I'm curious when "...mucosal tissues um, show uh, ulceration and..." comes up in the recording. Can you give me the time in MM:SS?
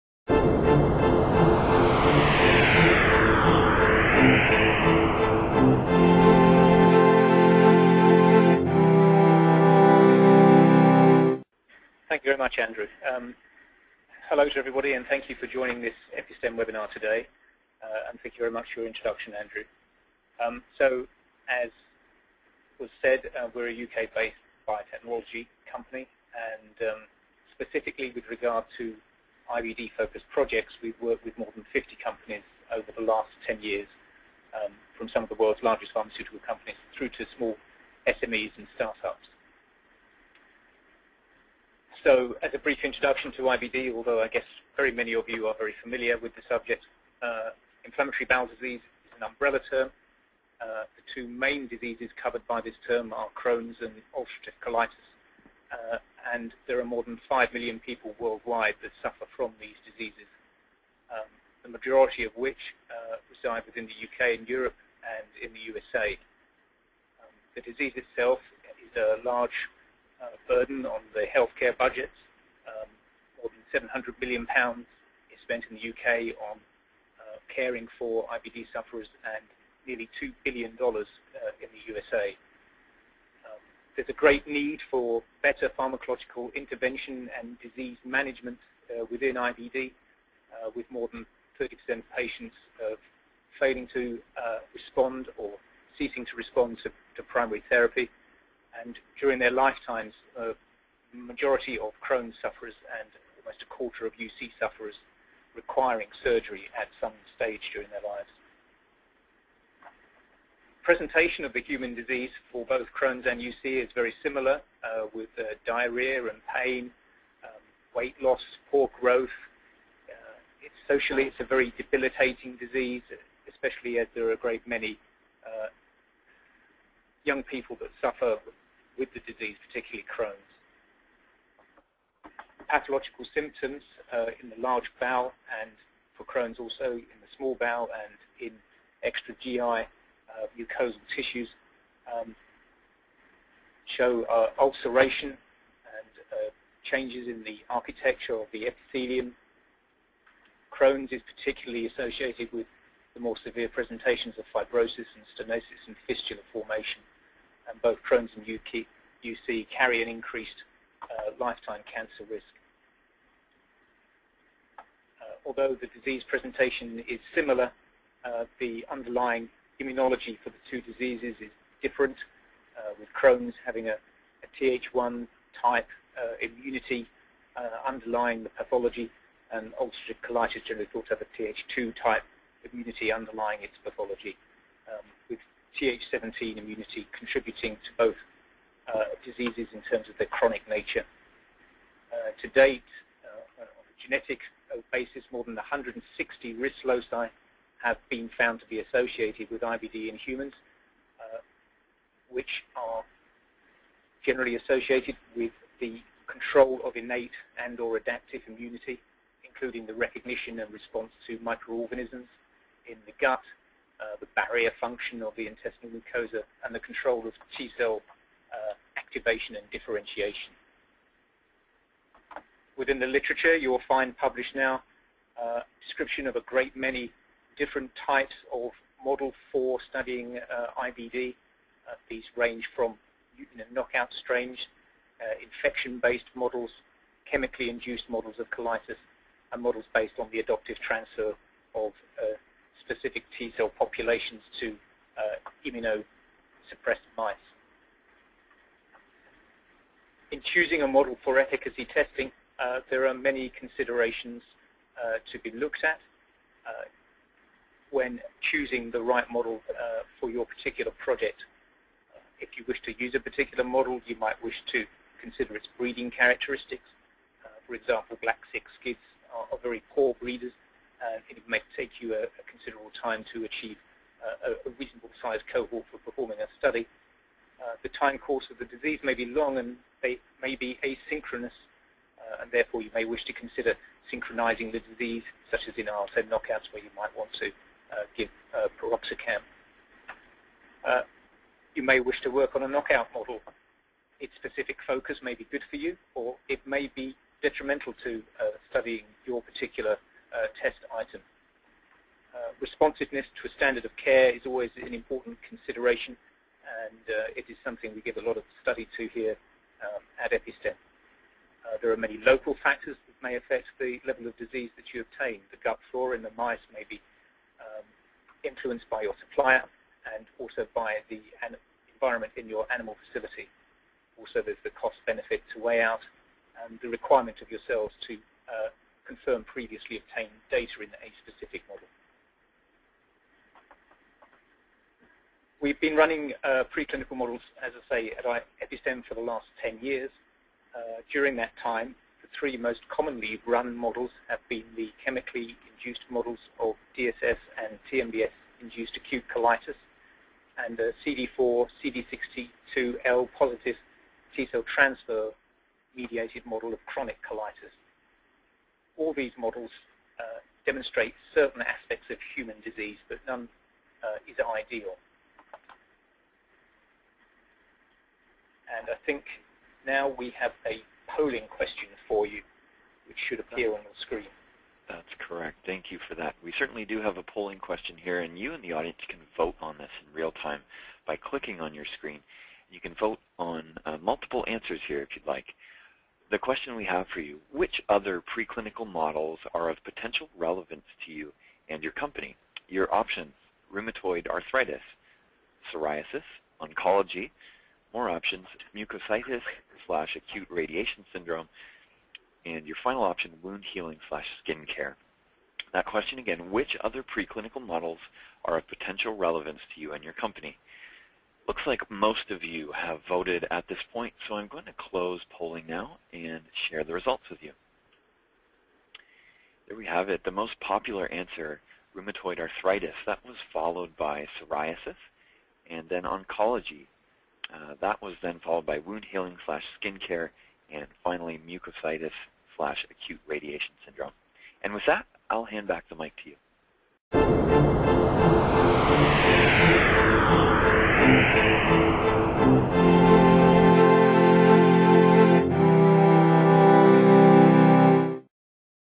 02:20.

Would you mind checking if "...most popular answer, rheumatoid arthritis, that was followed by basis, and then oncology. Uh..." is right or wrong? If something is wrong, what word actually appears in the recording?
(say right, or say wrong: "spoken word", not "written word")
wrong: "psoriasis", not "basis".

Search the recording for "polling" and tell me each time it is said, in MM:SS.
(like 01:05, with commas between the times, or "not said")
06:11, 06:17, 06:55.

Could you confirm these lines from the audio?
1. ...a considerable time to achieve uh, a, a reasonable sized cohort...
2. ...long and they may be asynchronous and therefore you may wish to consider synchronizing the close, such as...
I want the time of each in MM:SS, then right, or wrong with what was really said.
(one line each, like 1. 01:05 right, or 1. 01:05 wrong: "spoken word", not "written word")
1. 04:32 right
2. 04:39 wrong: "disease", not "close".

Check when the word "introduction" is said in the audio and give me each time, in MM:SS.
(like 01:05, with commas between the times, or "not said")
00:18, 00:42.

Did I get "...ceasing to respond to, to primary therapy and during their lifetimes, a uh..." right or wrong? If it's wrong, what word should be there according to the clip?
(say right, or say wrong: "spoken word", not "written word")
right.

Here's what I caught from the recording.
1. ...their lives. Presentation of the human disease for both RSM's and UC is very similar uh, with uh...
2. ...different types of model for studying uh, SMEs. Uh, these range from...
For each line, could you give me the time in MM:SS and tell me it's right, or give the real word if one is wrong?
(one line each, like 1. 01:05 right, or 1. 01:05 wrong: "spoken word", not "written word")
1. 01:47 wrong: "Crohn", not "RSM"
2. 03:47 wrong: "IBD", not "SMEs".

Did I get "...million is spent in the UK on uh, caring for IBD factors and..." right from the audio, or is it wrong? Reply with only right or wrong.
wrong.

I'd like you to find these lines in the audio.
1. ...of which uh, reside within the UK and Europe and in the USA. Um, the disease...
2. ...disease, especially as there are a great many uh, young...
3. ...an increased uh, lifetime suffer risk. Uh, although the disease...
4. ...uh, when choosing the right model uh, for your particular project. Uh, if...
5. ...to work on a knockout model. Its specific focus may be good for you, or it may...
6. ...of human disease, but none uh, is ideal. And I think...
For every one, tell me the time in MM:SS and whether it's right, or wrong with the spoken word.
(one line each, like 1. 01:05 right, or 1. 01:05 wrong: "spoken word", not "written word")
1. 01:02 right
2. 02:02 right
3. 02:40 wrong: "cancer", not "suffer"
4. 04:16 right
5. 04:52 right
6. 06:02 right.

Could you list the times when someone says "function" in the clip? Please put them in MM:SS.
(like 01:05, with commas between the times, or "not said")
03:34.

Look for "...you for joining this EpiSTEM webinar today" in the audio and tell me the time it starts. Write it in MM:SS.
00:15.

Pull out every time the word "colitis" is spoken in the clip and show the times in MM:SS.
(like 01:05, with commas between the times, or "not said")
00:54, 03:00, 03:58, 05:49, 05:57.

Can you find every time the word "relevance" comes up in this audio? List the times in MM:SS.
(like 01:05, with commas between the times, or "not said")
06:30, 06:49.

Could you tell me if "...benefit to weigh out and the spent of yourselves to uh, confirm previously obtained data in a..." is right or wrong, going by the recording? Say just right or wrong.
wrong.